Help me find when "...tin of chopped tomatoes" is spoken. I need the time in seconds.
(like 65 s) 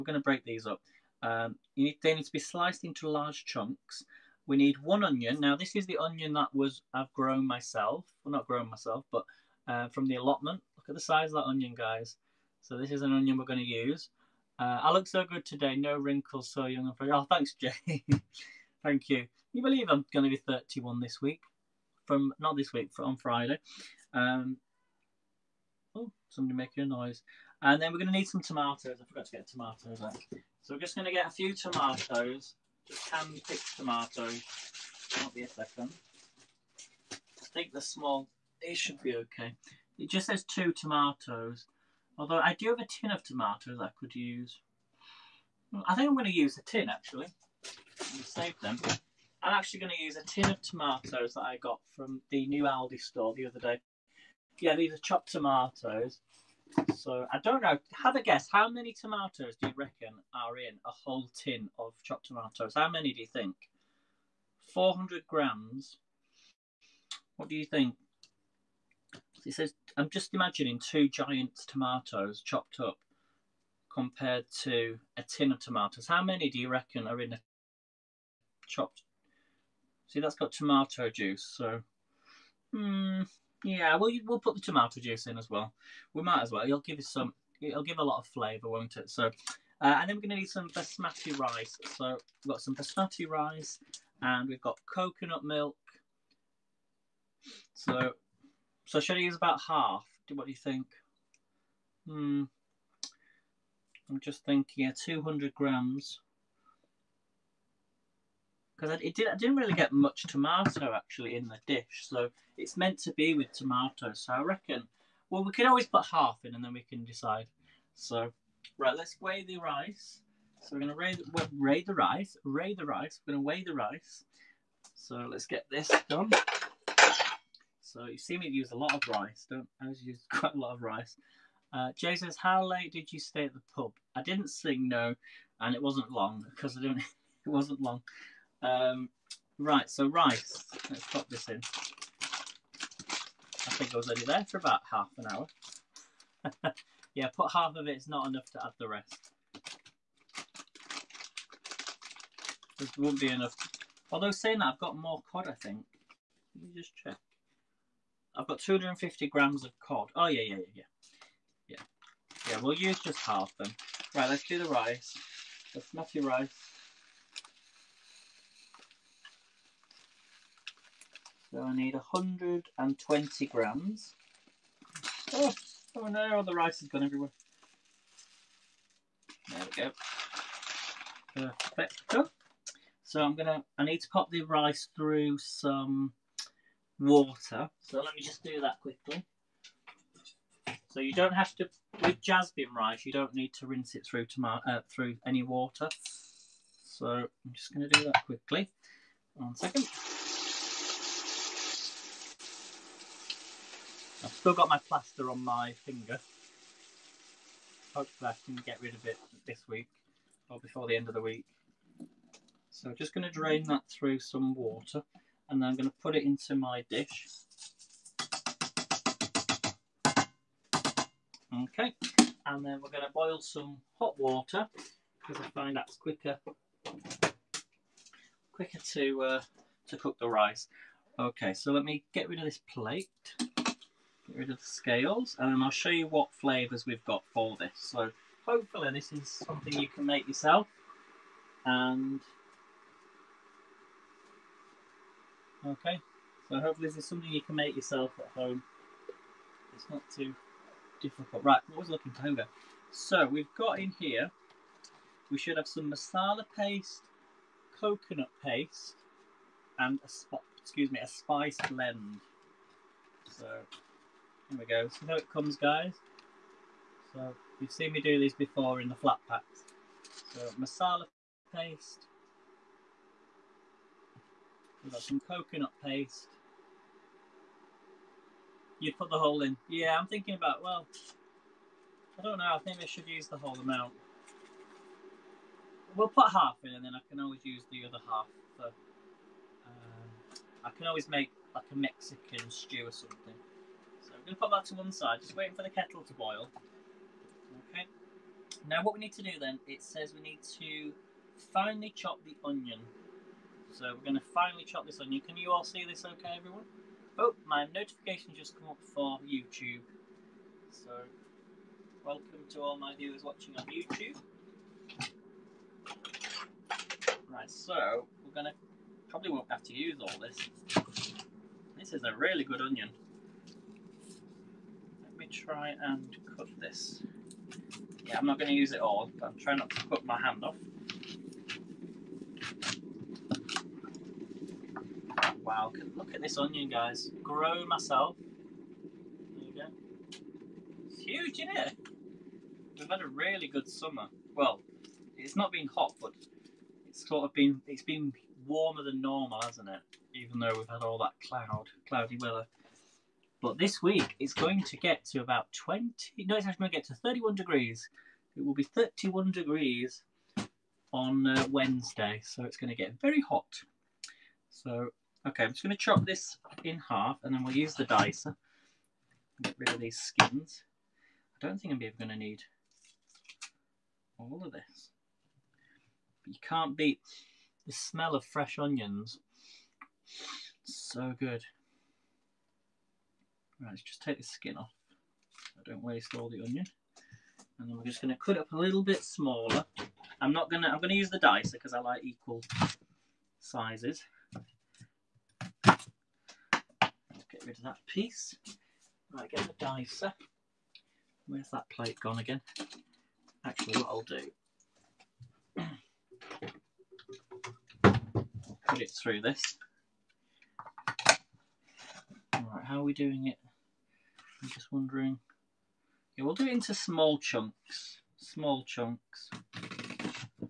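61 s.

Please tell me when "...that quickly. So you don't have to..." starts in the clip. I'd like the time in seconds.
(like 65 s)
188 s.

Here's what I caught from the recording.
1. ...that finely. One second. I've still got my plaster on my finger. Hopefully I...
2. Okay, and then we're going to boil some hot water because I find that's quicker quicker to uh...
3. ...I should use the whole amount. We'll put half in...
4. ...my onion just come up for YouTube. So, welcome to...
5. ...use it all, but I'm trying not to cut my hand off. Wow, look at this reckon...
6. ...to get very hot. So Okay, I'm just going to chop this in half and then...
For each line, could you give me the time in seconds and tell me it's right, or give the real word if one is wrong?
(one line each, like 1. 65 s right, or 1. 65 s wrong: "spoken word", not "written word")
1. 198 s wrong: "quickly", not "finely"
2. 221 s right
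3. 282 s right
4. 307 s wrong: "notification", not "onion"
5. 328 s wrong: "onion", not "reckon"
6. 362 s right.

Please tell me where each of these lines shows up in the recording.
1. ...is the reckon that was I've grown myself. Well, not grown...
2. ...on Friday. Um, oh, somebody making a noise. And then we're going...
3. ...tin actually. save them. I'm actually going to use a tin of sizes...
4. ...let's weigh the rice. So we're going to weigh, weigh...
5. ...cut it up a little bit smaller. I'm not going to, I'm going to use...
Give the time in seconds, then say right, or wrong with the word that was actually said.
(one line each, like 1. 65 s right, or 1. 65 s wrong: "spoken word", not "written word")
1. 5 s wrong: "onion", not "reckon"
2. 23 s right
3. 46 s wrong: "tomatoes", not "sizes"
4. 118 s right
5. 388 s right.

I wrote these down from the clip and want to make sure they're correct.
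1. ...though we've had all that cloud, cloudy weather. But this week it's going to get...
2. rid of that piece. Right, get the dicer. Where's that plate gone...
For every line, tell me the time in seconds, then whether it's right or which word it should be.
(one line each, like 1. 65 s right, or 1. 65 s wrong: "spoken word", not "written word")
1. 350 s right
2. 397 s right.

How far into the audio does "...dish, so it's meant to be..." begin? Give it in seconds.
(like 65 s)
111 s.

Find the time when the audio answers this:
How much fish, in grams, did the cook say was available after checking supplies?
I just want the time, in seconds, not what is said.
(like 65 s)
158 s.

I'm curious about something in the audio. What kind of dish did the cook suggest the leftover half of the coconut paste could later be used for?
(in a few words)
Mexican stew.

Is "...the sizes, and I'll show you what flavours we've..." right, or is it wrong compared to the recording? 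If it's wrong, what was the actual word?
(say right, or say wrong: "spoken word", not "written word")
wrong: "scales", not "sizes".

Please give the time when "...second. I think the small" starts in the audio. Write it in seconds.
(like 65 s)
35 s.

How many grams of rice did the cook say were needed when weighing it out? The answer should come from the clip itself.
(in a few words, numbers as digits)
120 grams.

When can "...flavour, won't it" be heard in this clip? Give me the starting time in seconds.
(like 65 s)
88 s.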